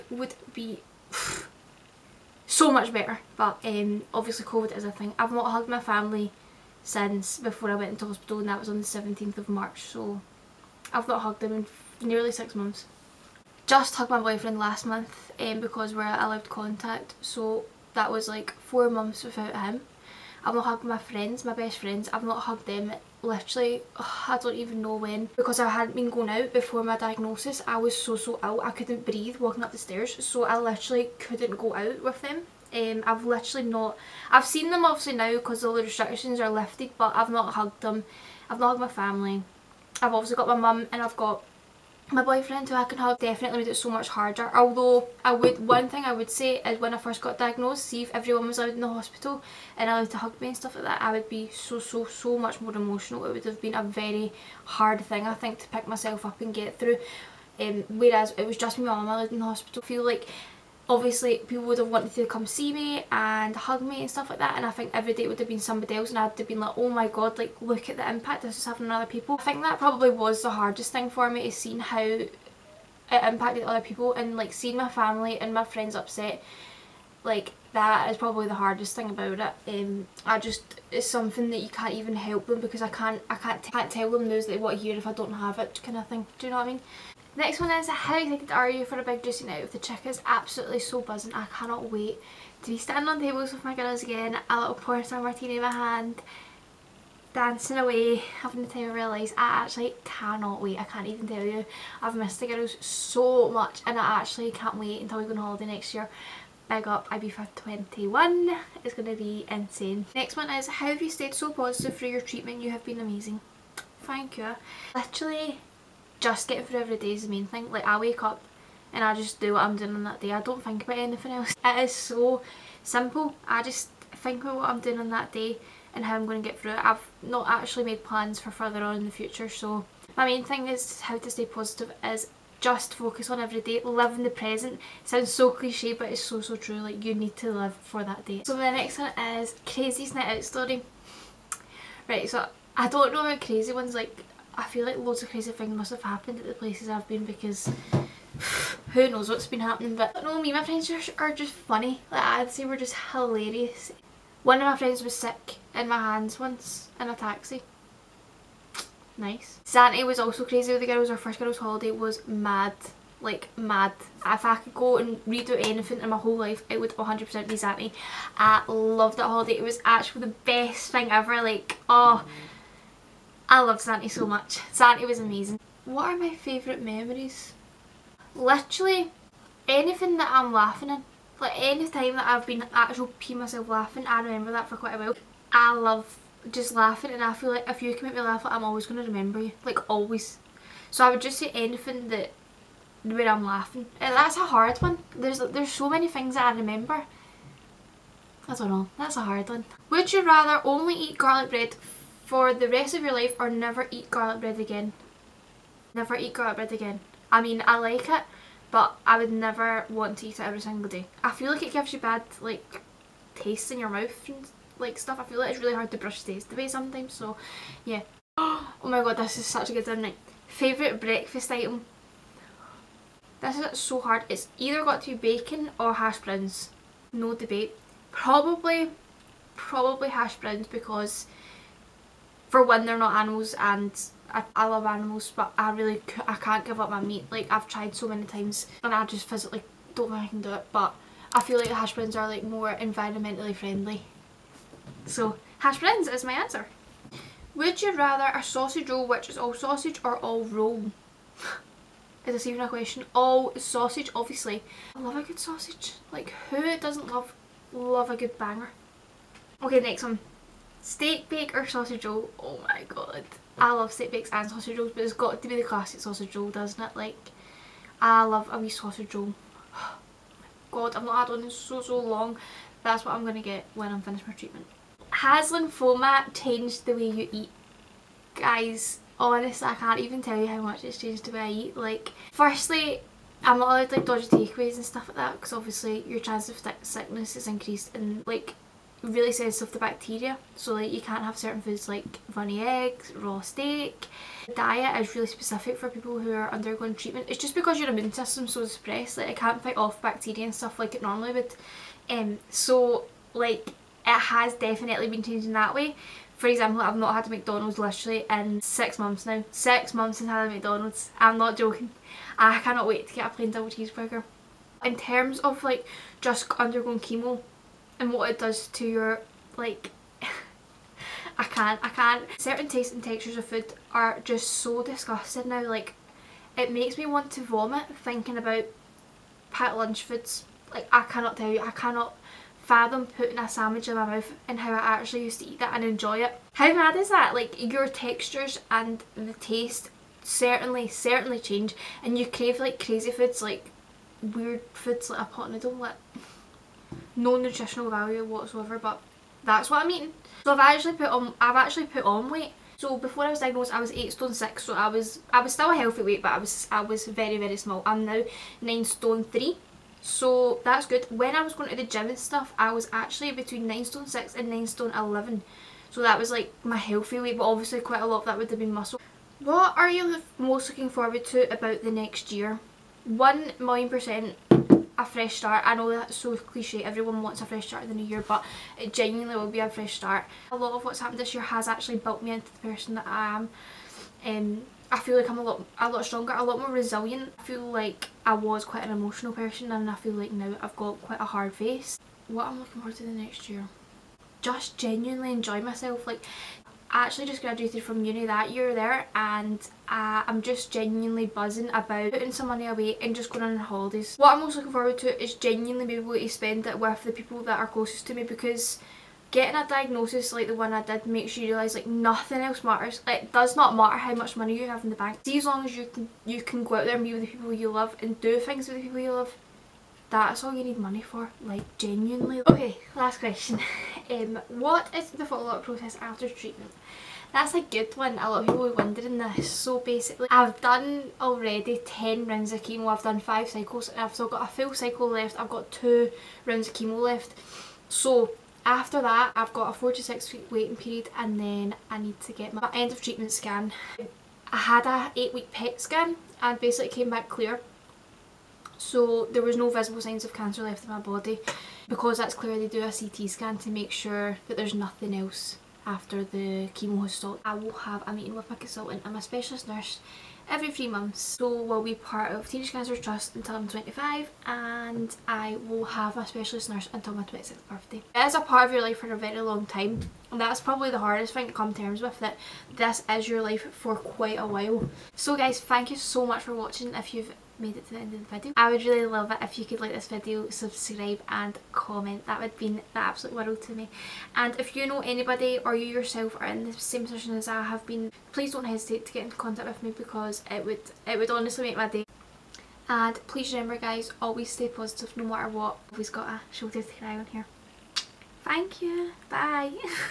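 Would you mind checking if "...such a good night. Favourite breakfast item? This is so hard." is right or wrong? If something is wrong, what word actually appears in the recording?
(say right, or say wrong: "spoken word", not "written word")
right.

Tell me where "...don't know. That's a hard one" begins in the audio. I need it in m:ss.
3:18.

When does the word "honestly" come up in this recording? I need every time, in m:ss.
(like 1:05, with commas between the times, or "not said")
4:39, 8:11.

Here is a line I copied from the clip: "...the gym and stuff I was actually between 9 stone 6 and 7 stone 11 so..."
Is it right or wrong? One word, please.
wrong.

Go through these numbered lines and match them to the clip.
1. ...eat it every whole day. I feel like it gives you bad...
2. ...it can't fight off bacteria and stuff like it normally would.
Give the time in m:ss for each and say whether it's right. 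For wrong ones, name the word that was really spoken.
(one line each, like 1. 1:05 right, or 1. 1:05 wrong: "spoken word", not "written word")
1. 3:30 wrong: "single", not "whole"
2. 4:59 right.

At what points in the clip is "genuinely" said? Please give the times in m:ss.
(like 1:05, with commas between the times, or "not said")
6:18, 6:34, 6:40, 6:45, 7:01.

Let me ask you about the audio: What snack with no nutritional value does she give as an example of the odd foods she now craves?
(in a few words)
pot noodle.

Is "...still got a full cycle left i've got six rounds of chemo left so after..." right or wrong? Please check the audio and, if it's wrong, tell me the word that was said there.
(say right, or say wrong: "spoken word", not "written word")
wrong: "two", not "six".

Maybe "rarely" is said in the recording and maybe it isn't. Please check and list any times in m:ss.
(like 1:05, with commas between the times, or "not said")
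not said.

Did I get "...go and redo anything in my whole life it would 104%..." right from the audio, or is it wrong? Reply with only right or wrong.
wrong.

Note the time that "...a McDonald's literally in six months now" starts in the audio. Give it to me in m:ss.
5:07.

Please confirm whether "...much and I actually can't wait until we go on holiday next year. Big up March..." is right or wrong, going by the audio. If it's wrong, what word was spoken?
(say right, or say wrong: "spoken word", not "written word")
wrong: "Ibiza", not "March".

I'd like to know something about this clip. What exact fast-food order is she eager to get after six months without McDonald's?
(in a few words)
plain double cheeseburger.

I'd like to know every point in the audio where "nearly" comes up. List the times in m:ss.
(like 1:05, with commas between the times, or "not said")
0:12.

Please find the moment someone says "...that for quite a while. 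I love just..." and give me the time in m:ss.
3:04.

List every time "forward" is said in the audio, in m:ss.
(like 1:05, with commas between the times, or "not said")
6:10, 6:32, 6:44.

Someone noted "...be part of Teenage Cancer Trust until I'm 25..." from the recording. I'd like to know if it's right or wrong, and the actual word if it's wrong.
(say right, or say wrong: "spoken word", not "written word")
right.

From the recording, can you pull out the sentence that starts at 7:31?
Because that's clear they do a CT scan to make sure that there's nothing else after the chemo has stopped.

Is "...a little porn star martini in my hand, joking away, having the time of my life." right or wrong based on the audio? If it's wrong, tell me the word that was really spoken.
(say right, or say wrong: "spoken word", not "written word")
wrong: "dancing", not "joking".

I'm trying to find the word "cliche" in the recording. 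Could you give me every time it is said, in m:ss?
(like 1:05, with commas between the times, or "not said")
2:15, 6:16.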